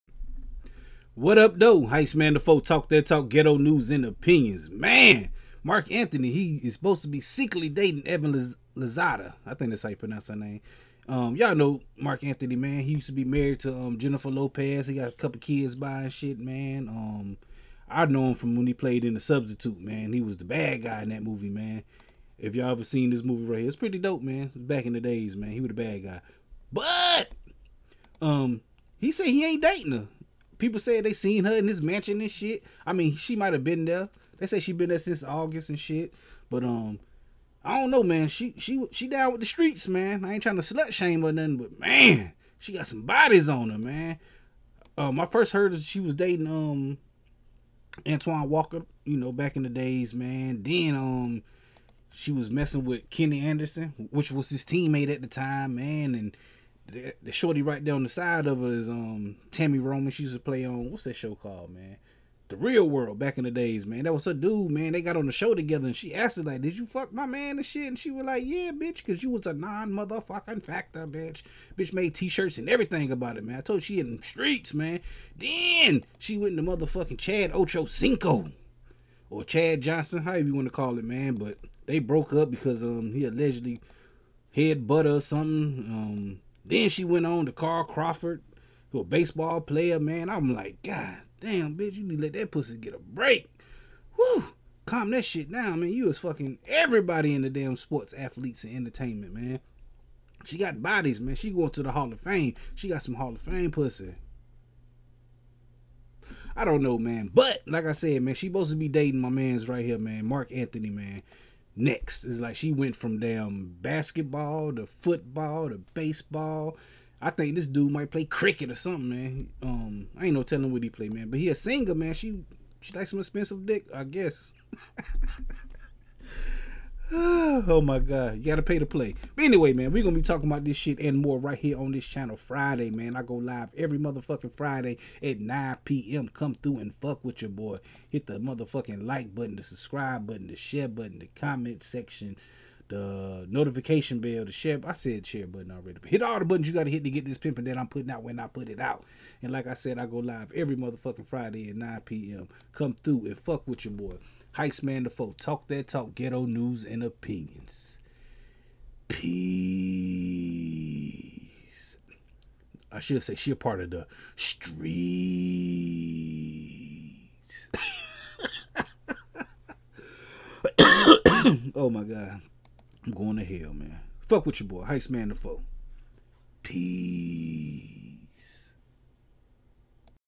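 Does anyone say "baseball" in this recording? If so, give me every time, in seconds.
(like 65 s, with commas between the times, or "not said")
89 s, 115 s.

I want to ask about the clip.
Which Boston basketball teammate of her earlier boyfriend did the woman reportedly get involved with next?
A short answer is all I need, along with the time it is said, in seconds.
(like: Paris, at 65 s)
Kenny Anderson, at 53 s.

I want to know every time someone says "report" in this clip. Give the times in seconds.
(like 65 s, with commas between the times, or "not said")
not said.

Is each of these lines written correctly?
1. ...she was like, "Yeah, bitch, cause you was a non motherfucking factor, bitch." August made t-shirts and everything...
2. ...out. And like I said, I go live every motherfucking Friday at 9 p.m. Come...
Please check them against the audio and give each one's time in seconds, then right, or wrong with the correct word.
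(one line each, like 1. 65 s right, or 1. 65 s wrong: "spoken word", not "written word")
1. 67 s wrong: "Bitch", not "August"
2. 148 s right.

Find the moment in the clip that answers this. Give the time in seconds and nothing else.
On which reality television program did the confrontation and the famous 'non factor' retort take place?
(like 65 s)
62 s.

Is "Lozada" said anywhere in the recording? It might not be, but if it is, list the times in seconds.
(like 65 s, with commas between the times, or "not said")
8 s.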